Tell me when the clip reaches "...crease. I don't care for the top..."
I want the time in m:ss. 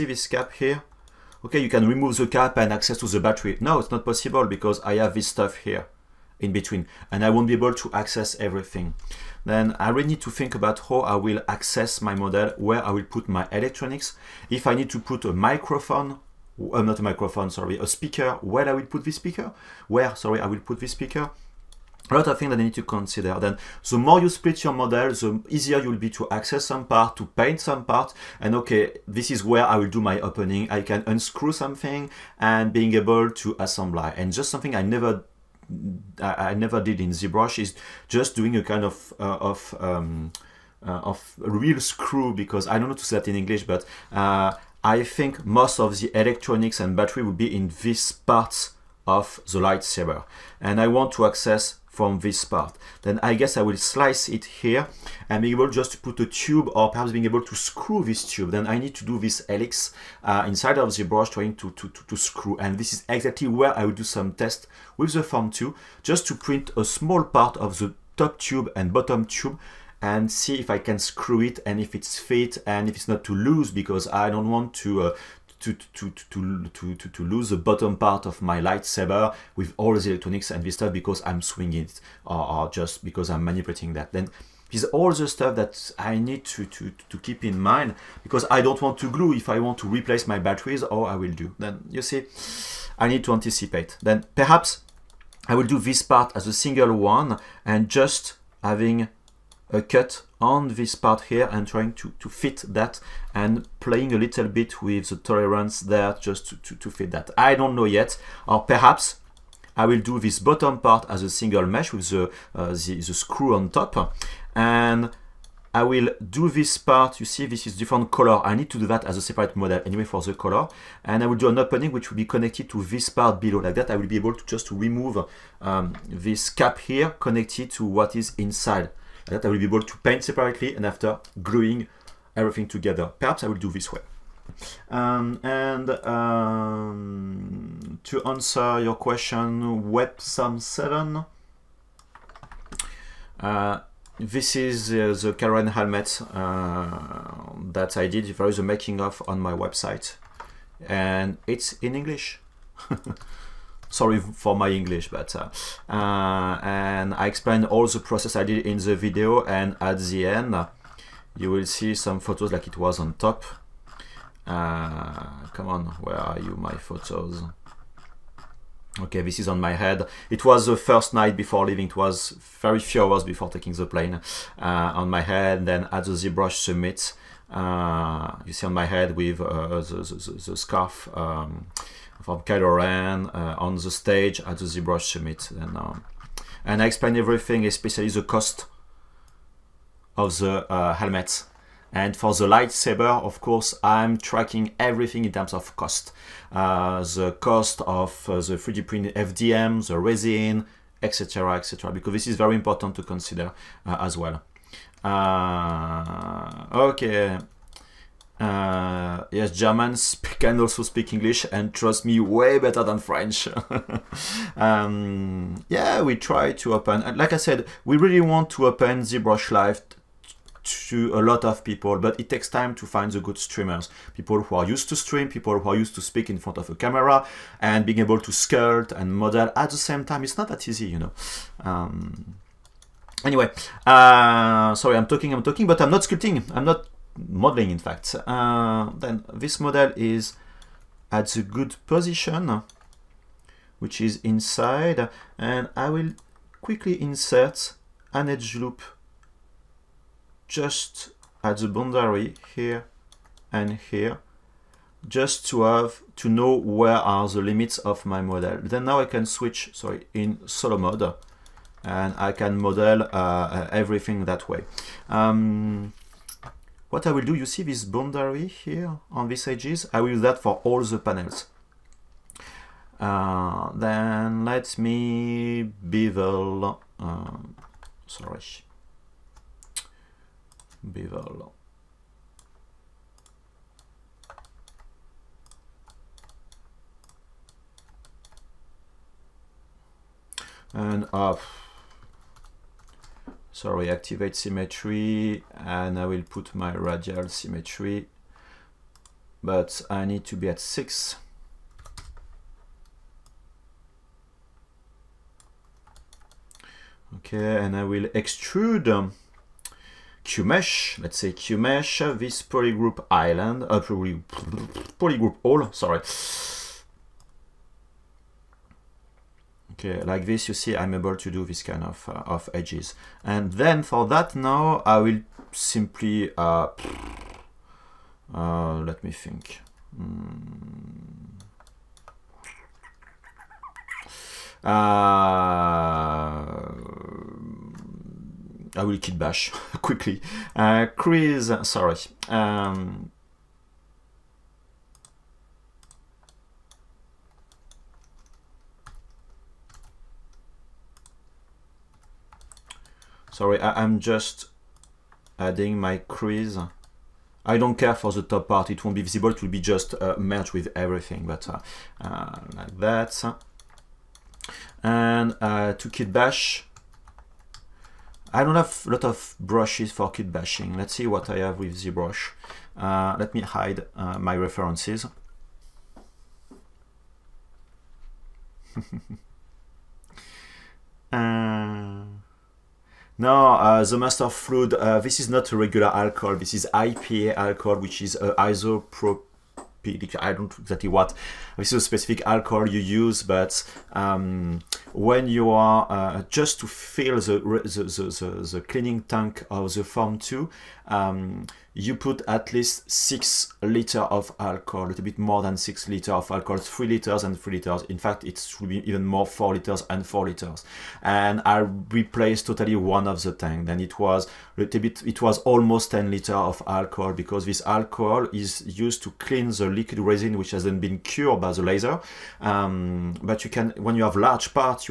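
5:55.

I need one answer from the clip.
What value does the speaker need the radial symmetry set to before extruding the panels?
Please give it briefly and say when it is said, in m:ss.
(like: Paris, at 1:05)
6, at 5:00.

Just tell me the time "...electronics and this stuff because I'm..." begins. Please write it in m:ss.
1:20.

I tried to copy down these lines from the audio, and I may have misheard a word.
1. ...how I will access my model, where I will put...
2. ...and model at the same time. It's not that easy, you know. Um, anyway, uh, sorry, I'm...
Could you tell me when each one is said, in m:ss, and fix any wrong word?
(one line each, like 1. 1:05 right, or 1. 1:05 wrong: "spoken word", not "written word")
1. 0:10 right
2. 3:48 right.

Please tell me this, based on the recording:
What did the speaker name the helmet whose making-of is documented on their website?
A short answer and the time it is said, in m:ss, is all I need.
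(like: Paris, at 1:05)
Karen helmet, at 2:25.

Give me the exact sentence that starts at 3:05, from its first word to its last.
And, um, and I explain everything, especially the cost of the uh, helmet.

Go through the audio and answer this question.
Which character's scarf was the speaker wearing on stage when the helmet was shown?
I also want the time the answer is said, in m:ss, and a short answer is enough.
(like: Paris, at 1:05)
Kylo Ren, at 3:02.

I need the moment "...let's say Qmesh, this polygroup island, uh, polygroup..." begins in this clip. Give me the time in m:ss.
5:10.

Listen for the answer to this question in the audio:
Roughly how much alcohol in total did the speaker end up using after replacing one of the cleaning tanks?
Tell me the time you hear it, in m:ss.
6:55.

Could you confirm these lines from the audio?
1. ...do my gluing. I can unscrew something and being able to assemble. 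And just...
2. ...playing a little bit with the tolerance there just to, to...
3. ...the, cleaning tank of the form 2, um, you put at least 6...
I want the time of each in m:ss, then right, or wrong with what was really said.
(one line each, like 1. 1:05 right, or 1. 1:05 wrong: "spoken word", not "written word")
1. 0:29 wrong: "opening", not "gluing"
2. 1:43 right
3. 6:38 right.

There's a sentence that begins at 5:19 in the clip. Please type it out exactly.
Okay, uh, like this, you see, I'm able to do this kind of, uh, of edges.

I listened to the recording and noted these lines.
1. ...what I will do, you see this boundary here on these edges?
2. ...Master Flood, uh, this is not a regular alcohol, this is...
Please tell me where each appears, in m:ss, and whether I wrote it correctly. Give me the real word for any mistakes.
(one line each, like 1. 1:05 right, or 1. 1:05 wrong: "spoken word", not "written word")
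1. 4:26 right
2. 6:23 right.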